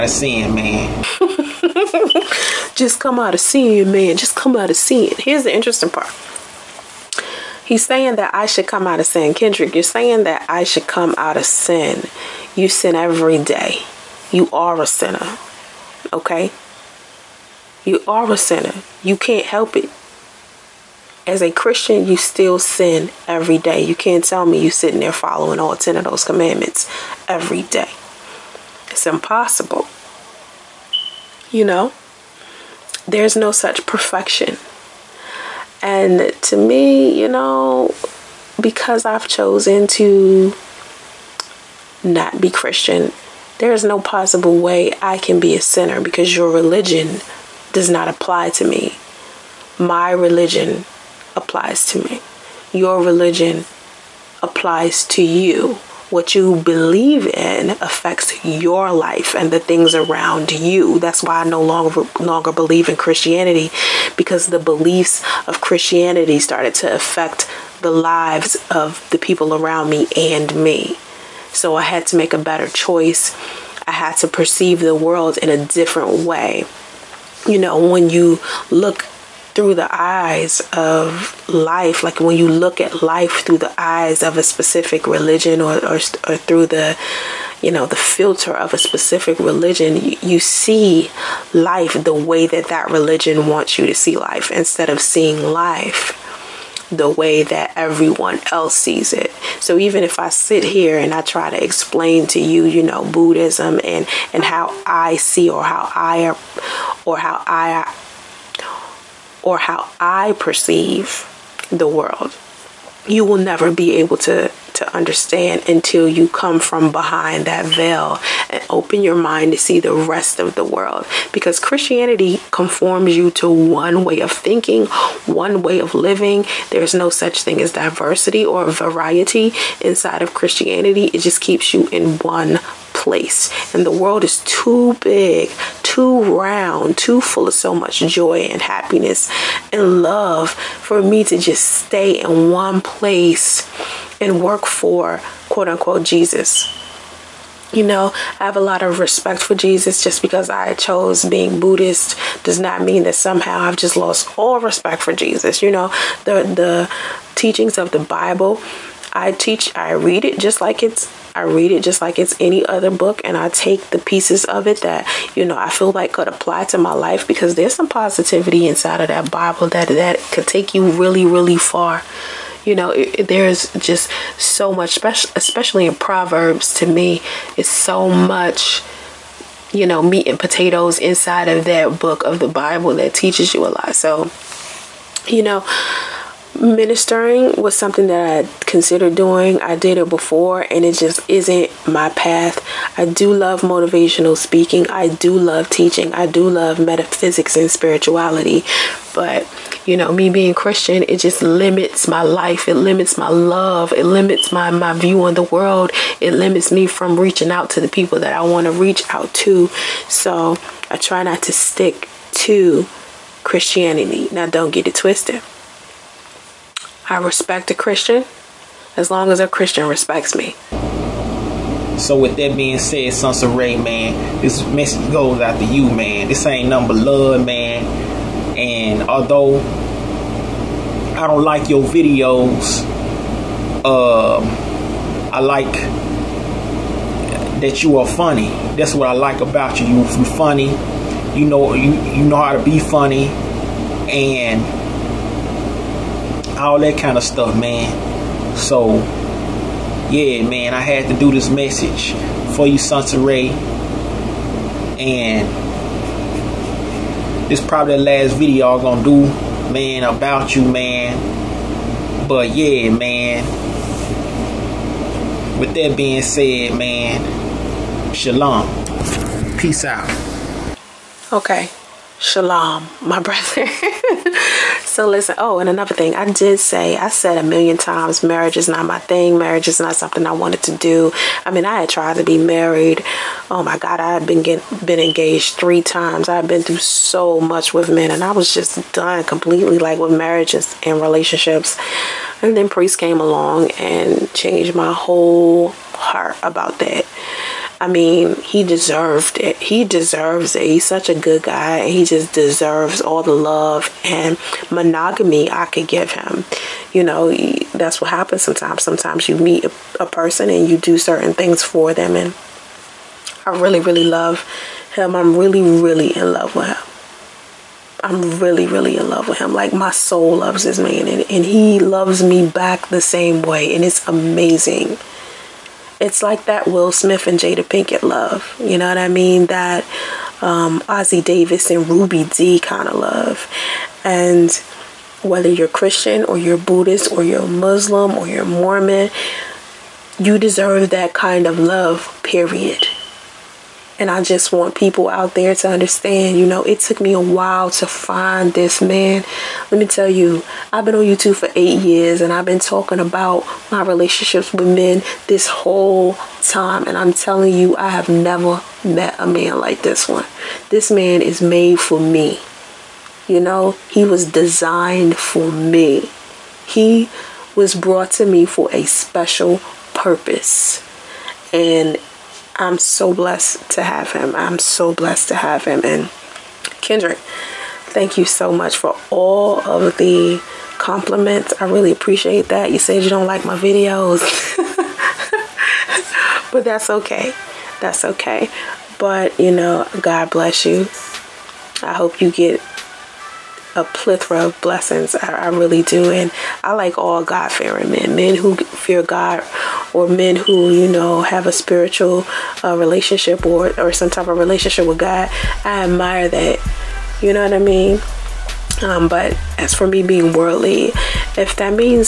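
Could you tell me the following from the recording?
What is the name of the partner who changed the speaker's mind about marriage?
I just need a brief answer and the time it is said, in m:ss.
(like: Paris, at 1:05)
Priest, at 4:52.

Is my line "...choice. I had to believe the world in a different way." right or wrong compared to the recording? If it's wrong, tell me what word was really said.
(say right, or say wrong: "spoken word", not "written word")
wrong: "perceive", not "believe".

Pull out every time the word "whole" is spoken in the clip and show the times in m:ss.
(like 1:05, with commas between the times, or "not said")
4:54, 5:55.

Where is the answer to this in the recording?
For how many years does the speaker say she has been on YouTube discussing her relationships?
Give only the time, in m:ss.
5:51.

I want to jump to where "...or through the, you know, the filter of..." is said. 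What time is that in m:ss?
1:25.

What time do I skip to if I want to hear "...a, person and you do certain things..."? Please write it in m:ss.
5:09.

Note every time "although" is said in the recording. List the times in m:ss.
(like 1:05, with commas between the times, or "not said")
3:49.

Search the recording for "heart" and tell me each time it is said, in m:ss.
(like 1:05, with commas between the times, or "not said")
4:55.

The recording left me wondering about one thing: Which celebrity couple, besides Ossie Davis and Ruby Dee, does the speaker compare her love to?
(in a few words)
Will Smith and Jada Pinkett.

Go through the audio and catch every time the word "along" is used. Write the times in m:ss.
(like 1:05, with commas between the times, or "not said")
4:53.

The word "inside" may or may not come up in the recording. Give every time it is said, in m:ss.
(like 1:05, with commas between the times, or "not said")
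2:09, 2:48, 3:00.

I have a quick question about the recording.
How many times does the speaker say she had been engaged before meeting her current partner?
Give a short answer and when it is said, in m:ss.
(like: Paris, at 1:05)
3, at 4:45.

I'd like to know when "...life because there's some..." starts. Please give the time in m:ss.
2:46.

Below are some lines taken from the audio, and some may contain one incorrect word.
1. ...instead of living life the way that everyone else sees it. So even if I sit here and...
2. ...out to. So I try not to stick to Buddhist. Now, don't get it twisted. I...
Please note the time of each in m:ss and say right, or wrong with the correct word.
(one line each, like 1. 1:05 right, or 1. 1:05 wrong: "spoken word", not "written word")
1. 1:34 wrong: "seeing", not "living"
2. 3:29 wrong: "Christianity", not "Buddhist".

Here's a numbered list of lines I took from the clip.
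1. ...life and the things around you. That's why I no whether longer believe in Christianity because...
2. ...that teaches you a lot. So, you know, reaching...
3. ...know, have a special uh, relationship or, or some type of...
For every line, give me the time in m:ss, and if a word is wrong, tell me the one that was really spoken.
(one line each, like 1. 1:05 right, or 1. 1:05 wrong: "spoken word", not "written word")
1. 0:58 wrong: "longer", not "whether"
2. 3:02 wrong: "ministering", not "reaching"
3. 6:40 wrong: "spiritual", not "special".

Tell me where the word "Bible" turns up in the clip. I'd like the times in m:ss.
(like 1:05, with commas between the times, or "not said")
2:37, 2:49, 3:02.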